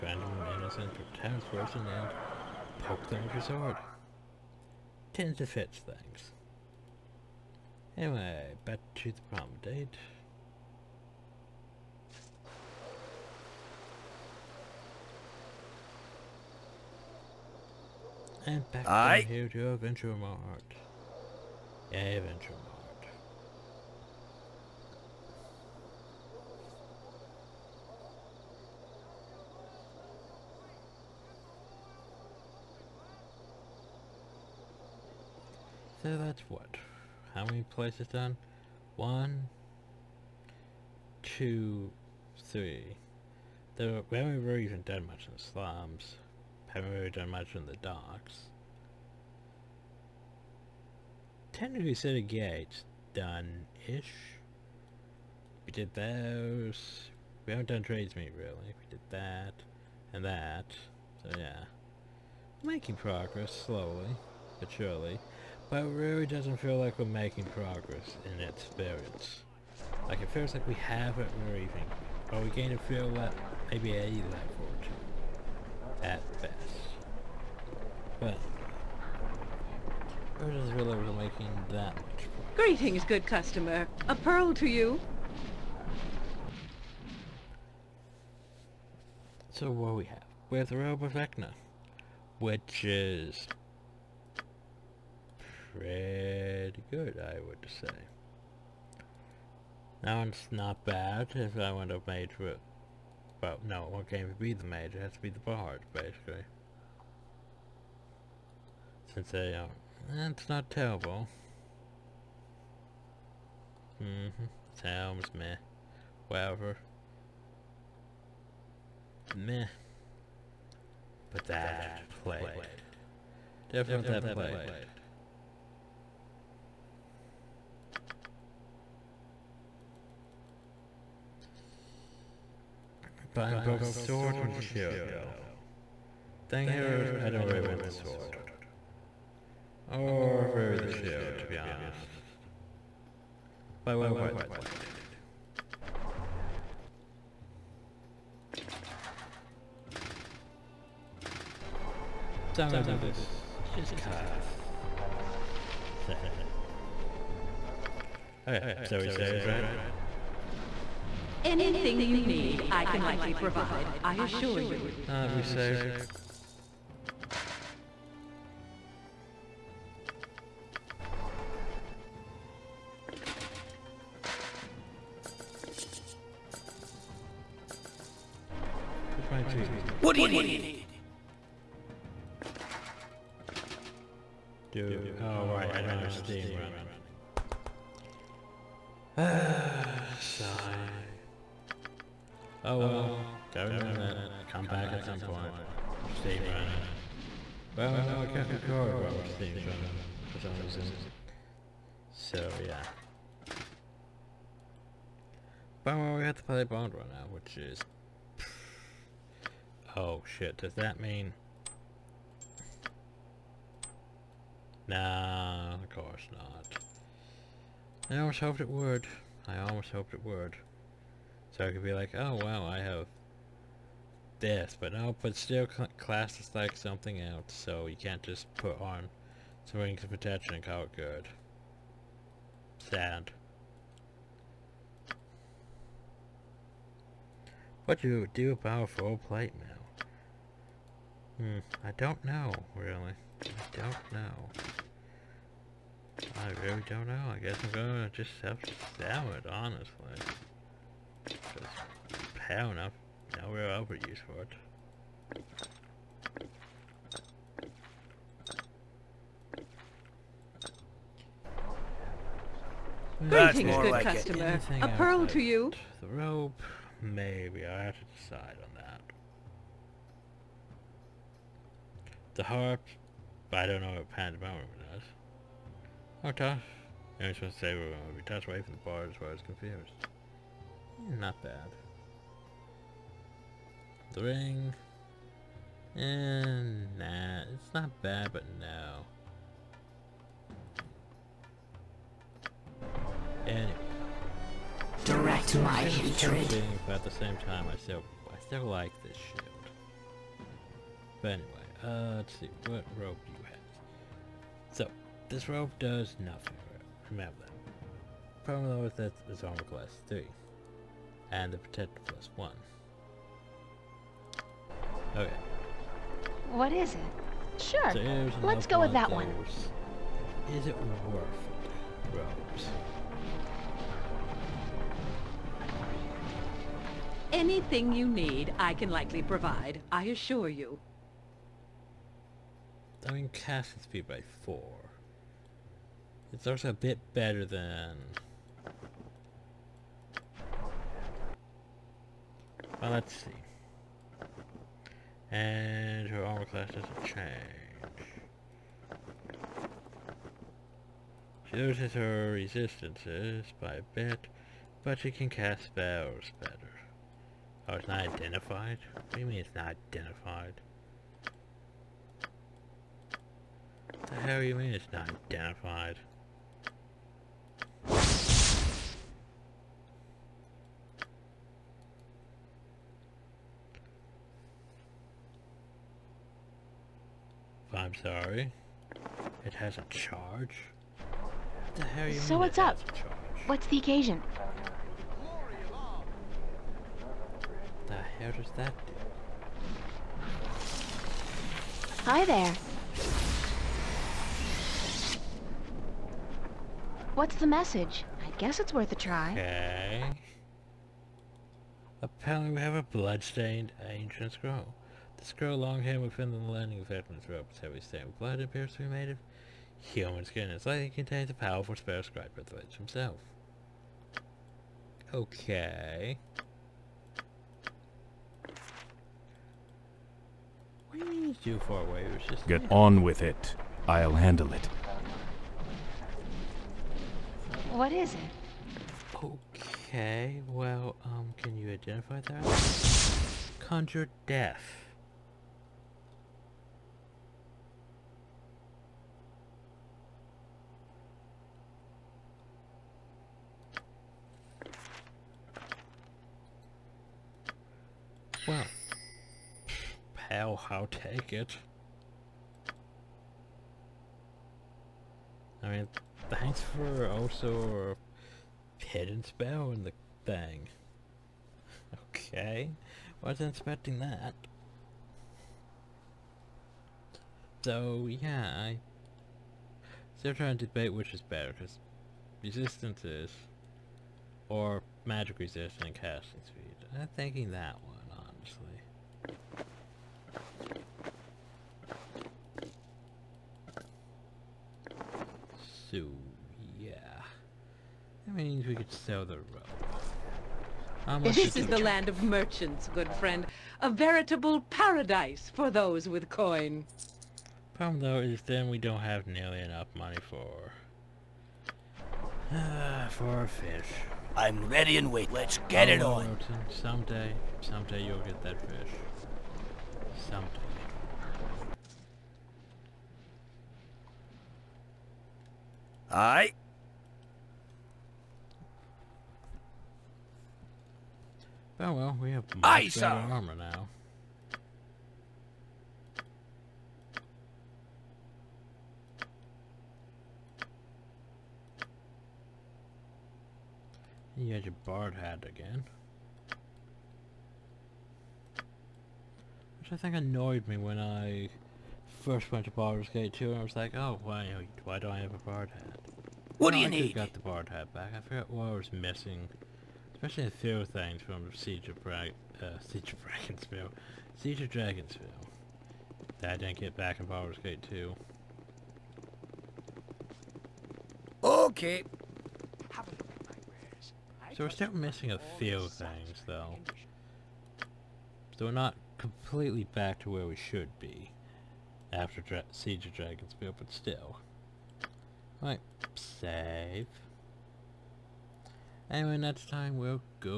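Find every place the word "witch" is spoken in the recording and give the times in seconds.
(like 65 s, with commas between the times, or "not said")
412 s.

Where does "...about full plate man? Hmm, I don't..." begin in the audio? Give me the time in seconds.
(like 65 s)
238 s.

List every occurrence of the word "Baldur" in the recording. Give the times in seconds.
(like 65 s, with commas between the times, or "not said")
542 s, 557 s.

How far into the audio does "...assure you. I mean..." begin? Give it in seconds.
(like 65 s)
330 s.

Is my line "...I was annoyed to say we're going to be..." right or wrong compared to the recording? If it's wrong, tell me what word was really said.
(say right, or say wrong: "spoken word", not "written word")
wrong: "supposed", not "annoyed".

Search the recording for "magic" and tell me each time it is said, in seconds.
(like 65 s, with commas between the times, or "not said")
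475 s.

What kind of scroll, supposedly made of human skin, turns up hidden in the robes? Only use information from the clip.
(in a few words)
blood-stained ancient scroll.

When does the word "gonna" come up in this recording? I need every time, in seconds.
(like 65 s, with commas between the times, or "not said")
152 s, 247 s.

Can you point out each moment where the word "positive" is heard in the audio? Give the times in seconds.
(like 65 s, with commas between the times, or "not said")
not said.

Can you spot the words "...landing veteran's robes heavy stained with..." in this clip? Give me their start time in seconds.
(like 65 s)
406 s.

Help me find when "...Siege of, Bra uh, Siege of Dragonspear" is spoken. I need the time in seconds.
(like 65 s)
551 s.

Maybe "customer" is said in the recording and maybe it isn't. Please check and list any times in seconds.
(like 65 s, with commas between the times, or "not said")
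83 s, 264 s.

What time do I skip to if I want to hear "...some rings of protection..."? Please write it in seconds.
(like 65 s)
229 s.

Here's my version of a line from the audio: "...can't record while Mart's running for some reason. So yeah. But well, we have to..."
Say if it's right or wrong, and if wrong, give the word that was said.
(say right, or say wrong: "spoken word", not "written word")
wrong: "Steam", not "Mart".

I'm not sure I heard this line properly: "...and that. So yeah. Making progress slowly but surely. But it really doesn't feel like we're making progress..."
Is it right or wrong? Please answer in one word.
right.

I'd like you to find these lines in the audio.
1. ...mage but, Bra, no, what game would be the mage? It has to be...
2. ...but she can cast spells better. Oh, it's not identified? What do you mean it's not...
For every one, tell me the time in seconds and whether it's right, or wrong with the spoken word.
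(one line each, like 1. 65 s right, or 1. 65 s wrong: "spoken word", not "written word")
1. 102 s wrong: "Well", not "Bra"
2. 354 s right.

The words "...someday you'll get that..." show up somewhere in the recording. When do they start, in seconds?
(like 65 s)
507 s.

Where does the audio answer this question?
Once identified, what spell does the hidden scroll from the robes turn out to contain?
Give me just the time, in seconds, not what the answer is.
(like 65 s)
433 s.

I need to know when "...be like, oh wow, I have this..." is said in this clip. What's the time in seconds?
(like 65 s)
221 s.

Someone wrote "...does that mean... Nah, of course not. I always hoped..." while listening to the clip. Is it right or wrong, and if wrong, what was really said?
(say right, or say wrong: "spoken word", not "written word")
right.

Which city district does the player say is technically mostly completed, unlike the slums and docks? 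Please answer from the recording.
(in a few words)
City Gate.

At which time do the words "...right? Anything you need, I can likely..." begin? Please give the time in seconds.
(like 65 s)
159 s.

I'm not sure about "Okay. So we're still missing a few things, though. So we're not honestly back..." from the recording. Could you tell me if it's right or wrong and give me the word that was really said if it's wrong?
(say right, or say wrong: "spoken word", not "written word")
wrong: "completely", not "honestly".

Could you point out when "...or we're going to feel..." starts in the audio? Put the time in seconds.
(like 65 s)
72 s.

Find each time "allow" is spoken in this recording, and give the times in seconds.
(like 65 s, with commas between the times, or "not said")
not said.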